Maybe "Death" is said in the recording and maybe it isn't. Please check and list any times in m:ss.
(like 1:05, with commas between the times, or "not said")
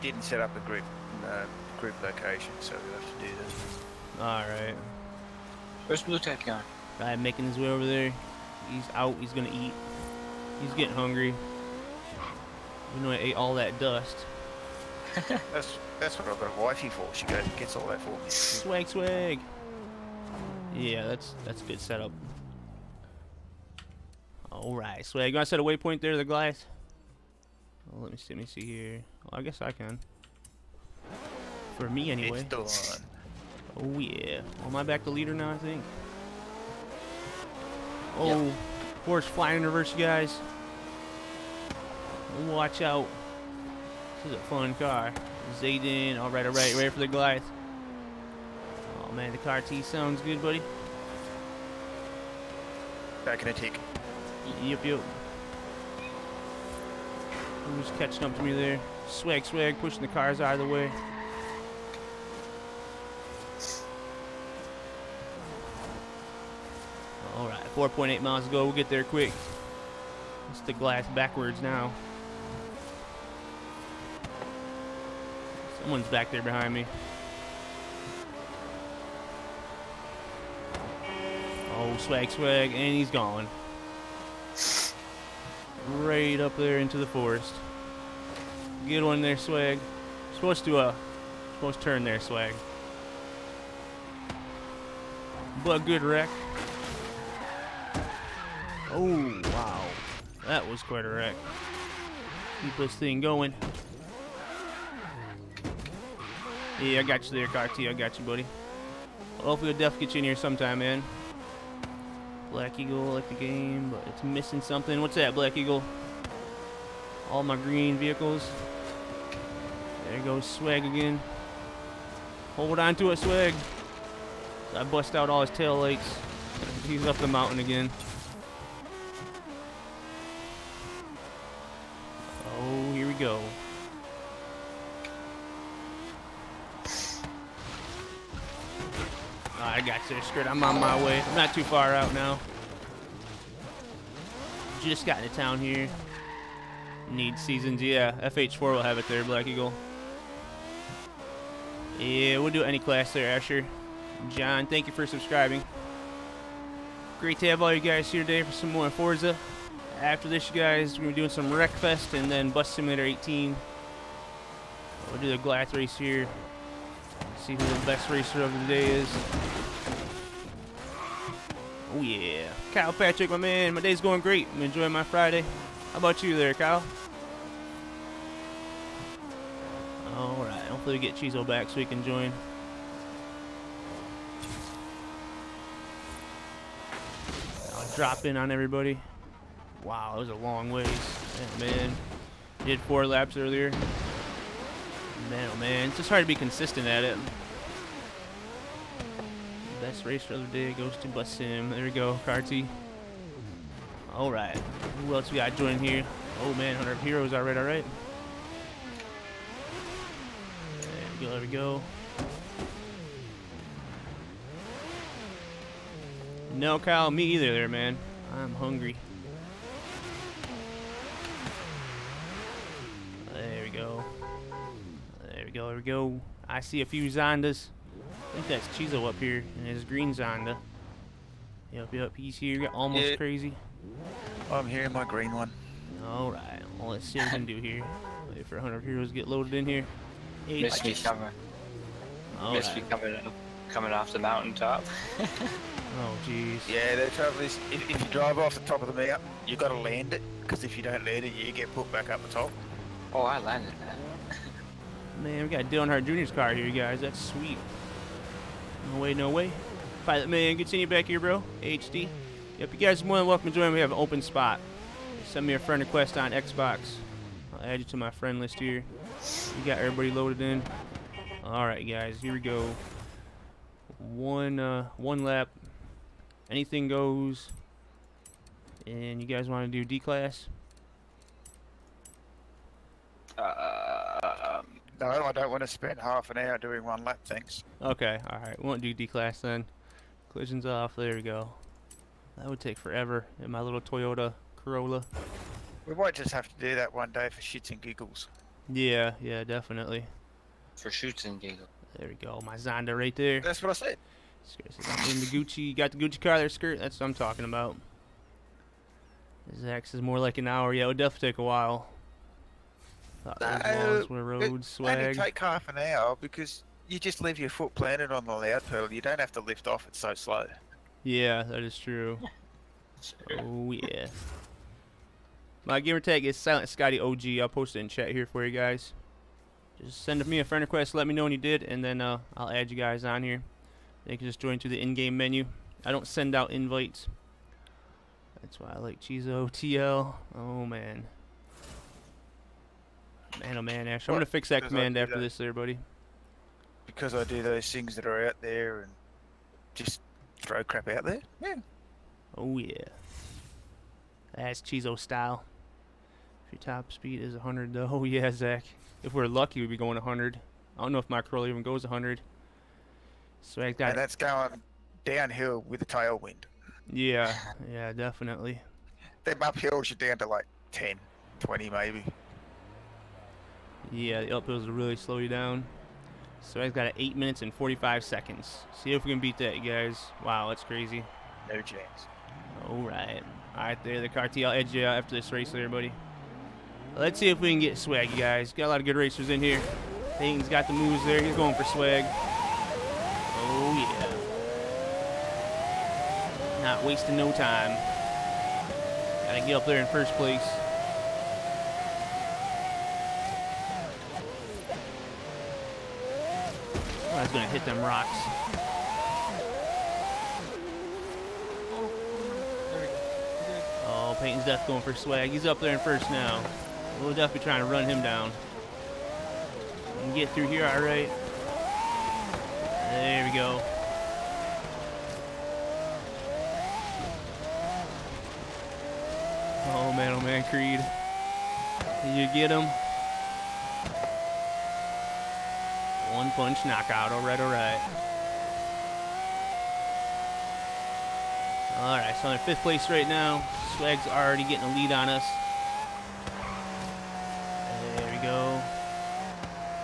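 6:54.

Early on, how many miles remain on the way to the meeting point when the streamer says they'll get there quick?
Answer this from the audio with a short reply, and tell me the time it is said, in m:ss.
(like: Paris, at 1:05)
4.8, at 1:07.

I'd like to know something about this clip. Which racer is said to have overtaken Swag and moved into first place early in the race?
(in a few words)
Peyton.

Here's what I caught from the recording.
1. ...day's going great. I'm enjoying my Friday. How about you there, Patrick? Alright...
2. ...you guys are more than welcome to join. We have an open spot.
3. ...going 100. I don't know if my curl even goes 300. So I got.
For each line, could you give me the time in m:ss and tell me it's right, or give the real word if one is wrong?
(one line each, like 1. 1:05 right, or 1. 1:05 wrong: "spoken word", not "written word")
1. 2:53 wrong: "Kyle", not "Patrick"
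2. 4:22 right
3. 5:59 wrong: "100", not "300".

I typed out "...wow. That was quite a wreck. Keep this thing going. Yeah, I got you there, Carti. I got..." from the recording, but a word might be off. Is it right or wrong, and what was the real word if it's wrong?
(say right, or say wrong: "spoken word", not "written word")
right.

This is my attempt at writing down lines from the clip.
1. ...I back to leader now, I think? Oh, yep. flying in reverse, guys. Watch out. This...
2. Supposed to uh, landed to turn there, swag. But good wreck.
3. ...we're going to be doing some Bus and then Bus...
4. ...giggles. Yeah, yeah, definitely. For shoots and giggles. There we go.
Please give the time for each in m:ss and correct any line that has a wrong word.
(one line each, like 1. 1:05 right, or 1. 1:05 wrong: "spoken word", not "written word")
1. 0:34 right
2. 1:30 wrong: "supposed", not "landed"
3. 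2:40 wrong: "Wreckfest", not "Bus"
4. 4:57 right.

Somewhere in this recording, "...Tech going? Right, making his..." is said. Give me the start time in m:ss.
0:06.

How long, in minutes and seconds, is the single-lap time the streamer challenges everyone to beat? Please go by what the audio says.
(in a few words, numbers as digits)
8 minutes 45 seconds.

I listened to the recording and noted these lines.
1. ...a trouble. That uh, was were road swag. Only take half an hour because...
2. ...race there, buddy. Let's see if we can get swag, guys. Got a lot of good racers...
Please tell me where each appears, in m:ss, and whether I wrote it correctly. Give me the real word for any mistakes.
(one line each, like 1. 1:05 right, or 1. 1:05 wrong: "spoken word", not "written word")
1. 5:11 wrong: "while", not "trouble"
2. 6:25 right.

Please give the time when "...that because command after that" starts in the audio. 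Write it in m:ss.
5:44.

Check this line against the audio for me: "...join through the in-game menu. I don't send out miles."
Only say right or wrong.
wrong.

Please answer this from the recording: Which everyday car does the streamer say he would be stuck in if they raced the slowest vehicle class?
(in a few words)
Toyota Corolla.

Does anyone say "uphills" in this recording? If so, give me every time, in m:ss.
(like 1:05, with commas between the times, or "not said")
6:09, 6:14.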